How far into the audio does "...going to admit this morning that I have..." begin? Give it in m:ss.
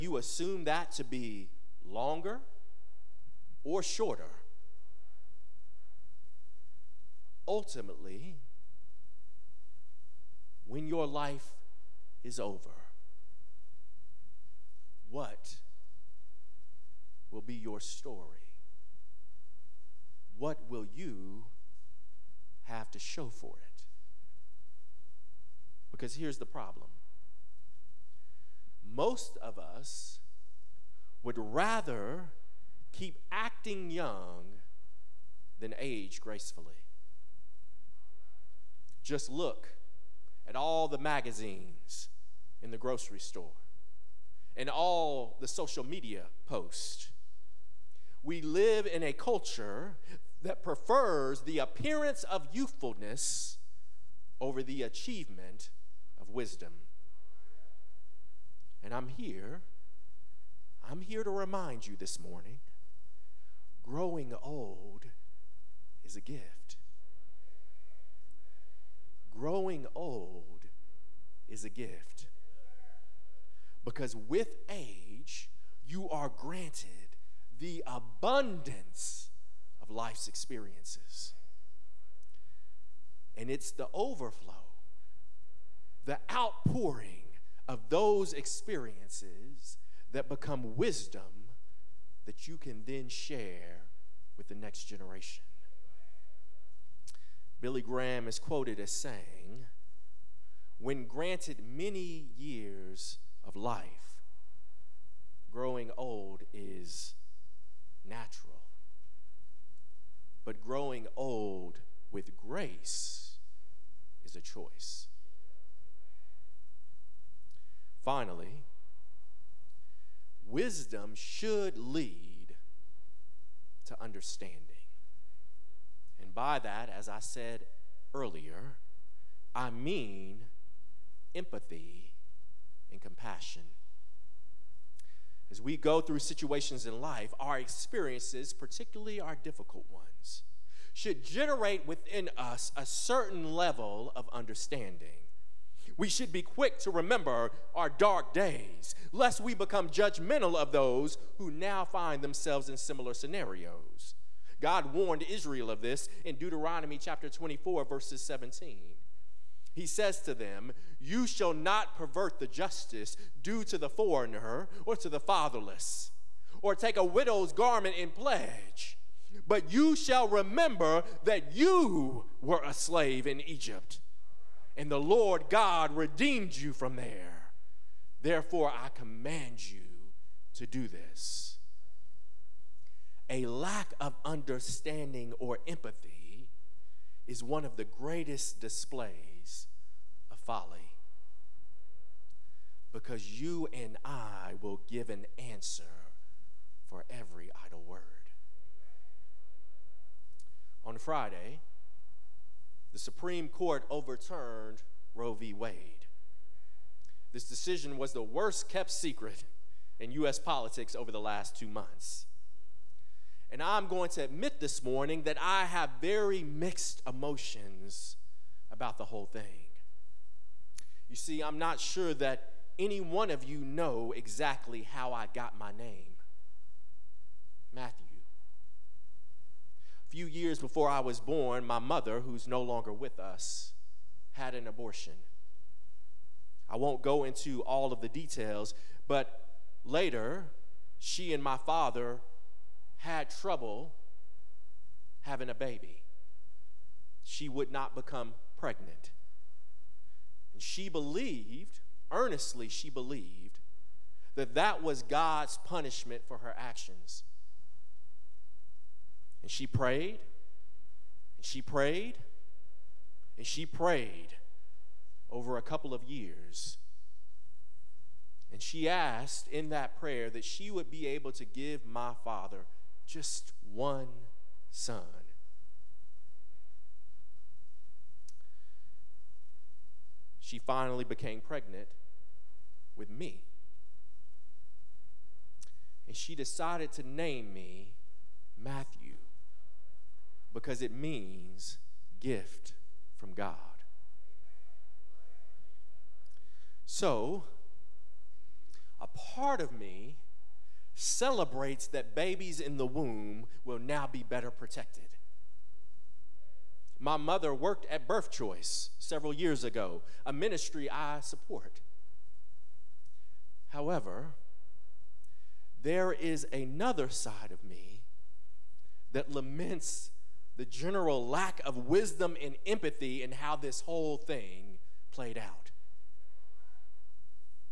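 3:33.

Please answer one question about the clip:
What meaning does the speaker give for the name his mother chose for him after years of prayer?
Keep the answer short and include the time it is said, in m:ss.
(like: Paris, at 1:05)
gift from God, at 4:52.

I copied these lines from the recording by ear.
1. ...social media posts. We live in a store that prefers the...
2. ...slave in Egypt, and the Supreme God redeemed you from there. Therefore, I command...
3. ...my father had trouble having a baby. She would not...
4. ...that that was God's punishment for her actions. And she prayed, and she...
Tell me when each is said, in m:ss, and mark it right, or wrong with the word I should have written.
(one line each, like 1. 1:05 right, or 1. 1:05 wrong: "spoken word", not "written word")
1. 0:45 wrong: "culture", not "store"
2. 2:52 wrong: "Lord", not "Supreme"
3. 4:01 right
4. 4:14 right.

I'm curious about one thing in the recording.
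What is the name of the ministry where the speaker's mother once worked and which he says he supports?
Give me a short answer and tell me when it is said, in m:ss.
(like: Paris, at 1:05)
Birth Choice, at 5:08.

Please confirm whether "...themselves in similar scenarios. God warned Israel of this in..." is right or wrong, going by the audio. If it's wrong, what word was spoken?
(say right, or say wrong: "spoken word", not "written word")
right.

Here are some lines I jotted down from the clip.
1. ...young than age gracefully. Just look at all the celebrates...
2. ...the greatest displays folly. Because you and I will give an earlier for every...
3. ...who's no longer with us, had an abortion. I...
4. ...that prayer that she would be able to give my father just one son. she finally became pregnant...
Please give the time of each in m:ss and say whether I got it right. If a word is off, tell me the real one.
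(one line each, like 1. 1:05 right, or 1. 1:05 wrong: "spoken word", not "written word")
1. 0:33 wrong: "magazines", not "celebrates"
2. 3:07 wrong: "answer", not "earlier"
3. 3:52 right
4. 4:29 right.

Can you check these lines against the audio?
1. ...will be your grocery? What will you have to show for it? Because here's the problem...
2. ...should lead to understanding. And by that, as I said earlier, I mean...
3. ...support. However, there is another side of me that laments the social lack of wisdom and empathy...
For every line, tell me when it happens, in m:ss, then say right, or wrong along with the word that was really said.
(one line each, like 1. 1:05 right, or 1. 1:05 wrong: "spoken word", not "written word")
1. 0:17 wrong: "story", not "grocery"
2. 2:01 right
3. 5:11 wrong: "general", not "social".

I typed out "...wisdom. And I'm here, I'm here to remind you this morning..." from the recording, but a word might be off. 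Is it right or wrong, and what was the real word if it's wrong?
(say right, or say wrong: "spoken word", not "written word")
right.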